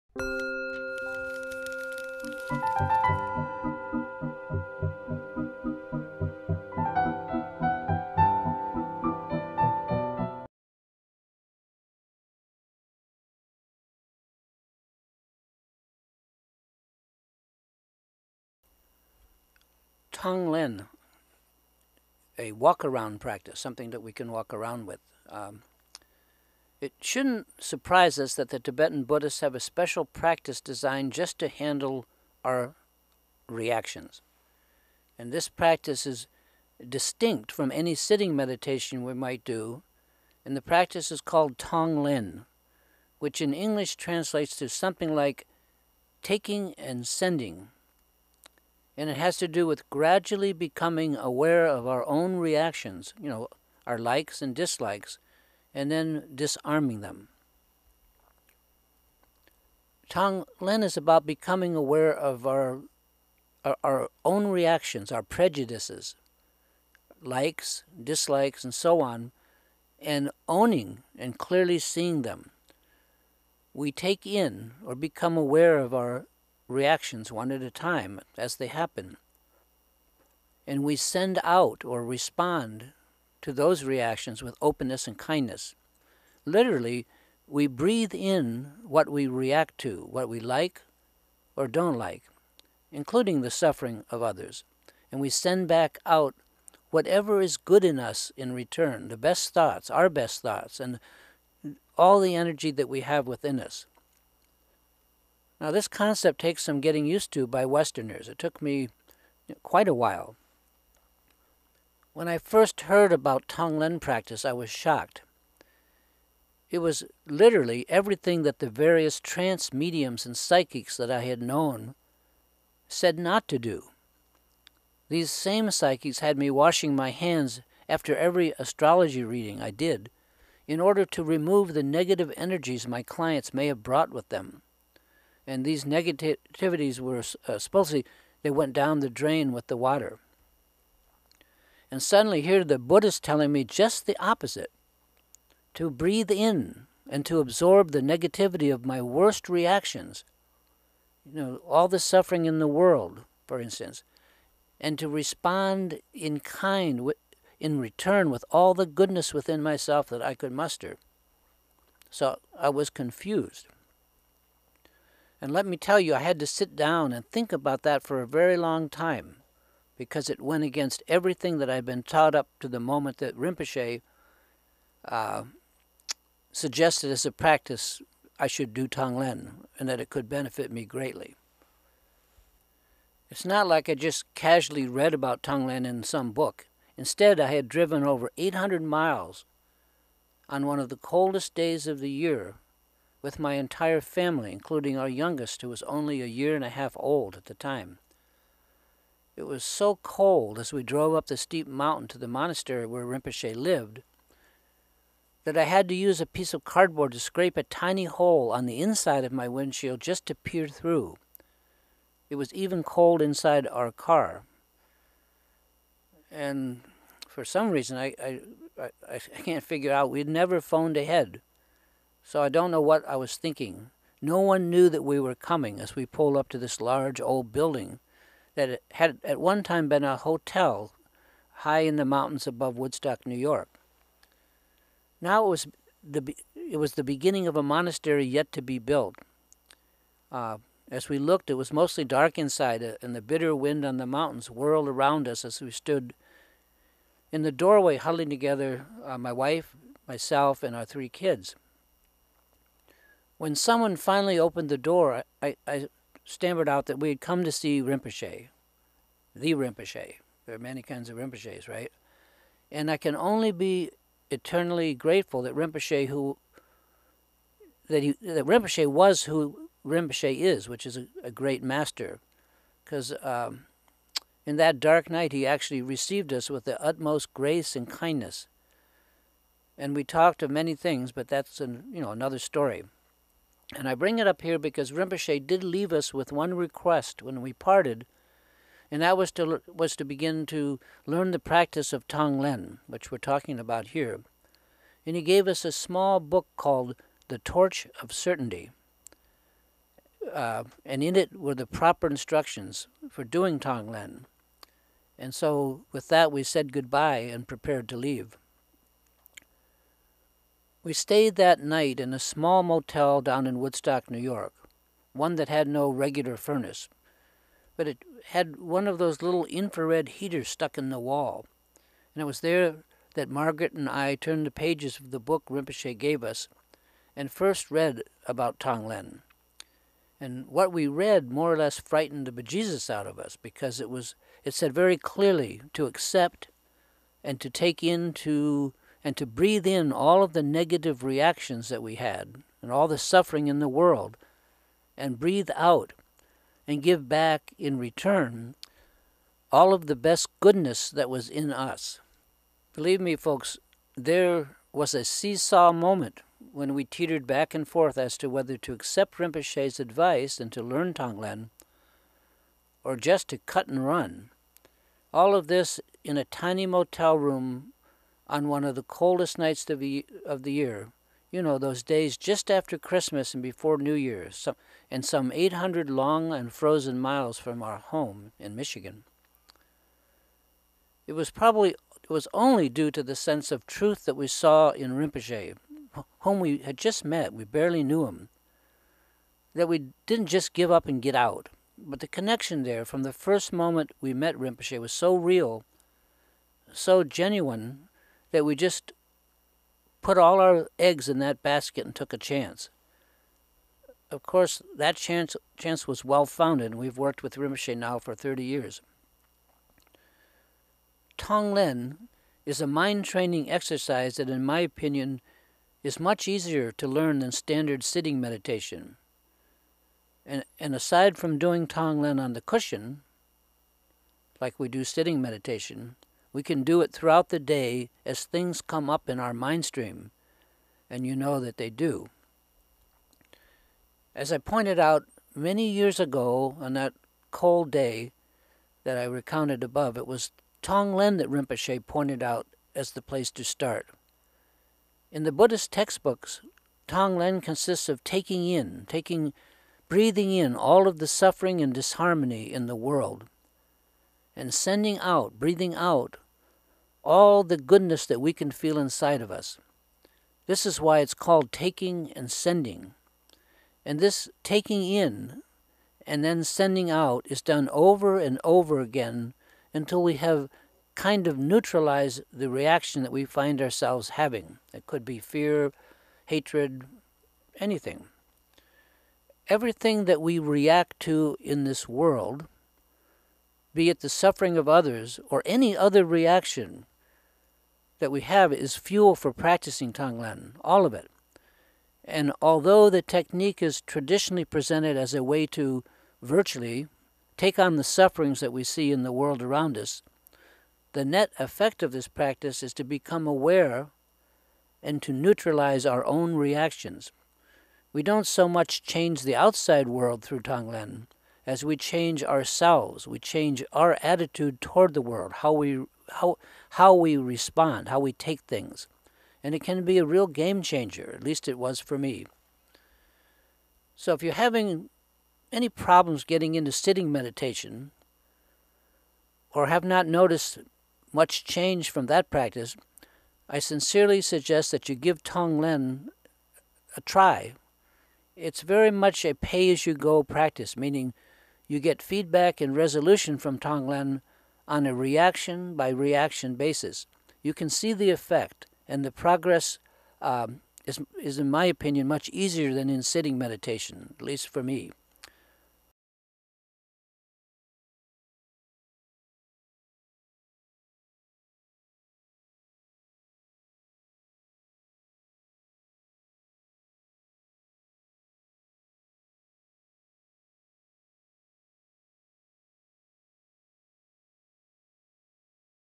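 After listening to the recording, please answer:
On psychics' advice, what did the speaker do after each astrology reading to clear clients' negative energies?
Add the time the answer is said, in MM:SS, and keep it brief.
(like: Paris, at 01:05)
washing my hands, at 02:06.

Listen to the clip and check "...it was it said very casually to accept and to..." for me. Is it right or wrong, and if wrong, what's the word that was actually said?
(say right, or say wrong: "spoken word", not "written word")
wrong: "clearly", not "casually".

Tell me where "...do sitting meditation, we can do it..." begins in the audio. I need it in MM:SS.
07:04.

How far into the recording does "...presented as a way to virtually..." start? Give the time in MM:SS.
08:14.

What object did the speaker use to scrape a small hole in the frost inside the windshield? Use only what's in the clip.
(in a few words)
cardboard.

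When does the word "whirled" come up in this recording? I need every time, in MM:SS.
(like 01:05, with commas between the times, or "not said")
04:04.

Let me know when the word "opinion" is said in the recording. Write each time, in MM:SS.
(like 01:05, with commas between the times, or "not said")
06:54, 09:11.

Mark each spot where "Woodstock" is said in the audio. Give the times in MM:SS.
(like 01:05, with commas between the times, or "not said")
03:52, 05:13.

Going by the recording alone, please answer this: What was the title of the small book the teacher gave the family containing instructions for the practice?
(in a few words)
The Torch of Certainty.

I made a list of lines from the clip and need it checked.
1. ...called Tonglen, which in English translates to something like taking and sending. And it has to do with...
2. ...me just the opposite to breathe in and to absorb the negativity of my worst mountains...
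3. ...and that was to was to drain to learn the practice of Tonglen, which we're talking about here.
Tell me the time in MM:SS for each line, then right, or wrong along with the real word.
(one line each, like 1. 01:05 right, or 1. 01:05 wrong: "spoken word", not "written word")
1. 00:41 right
2. 02:23 wrong: "reactions", not "mountains"
3. 04:48 wrong: "begin", not "drain".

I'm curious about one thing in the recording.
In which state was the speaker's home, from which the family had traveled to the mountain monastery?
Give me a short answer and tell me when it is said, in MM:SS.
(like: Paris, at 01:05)
Michigan, at 06:18.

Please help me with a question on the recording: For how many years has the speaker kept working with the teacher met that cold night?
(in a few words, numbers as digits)
30.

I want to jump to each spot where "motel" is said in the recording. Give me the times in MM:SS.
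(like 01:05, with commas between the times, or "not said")
05:12, 06:06.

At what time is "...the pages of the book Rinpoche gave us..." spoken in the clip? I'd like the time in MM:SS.
05:24.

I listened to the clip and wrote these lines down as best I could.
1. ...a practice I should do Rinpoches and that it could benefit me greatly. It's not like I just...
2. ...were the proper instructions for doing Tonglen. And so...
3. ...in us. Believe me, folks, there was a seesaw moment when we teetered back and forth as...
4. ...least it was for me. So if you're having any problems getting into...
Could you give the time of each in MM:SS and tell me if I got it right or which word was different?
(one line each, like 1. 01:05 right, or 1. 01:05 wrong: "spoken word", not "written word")
1. 02:57 wrong: "Tonglen", not "Rinpoches"
2. 05:01 right
3. 05:51 right
4. 08:41 right.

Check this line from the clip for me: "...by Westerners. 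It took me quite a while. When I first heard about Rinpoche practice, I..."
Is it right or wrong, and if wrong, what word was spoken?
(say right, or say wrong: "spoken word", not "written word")
wrong: "Tonglen", not "Rinpoche".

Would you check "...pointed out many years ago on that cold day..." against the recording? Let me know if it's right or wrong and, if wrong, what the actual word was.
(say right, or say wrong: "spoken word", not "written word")
right.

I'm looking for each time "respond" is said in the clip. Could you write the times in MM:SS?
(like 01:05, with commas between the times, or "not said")
01:22, 02:35, 08:37.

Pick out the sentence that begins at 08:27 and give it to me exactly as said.
We don't so much change the outside world through Tonglen as we change ourselves.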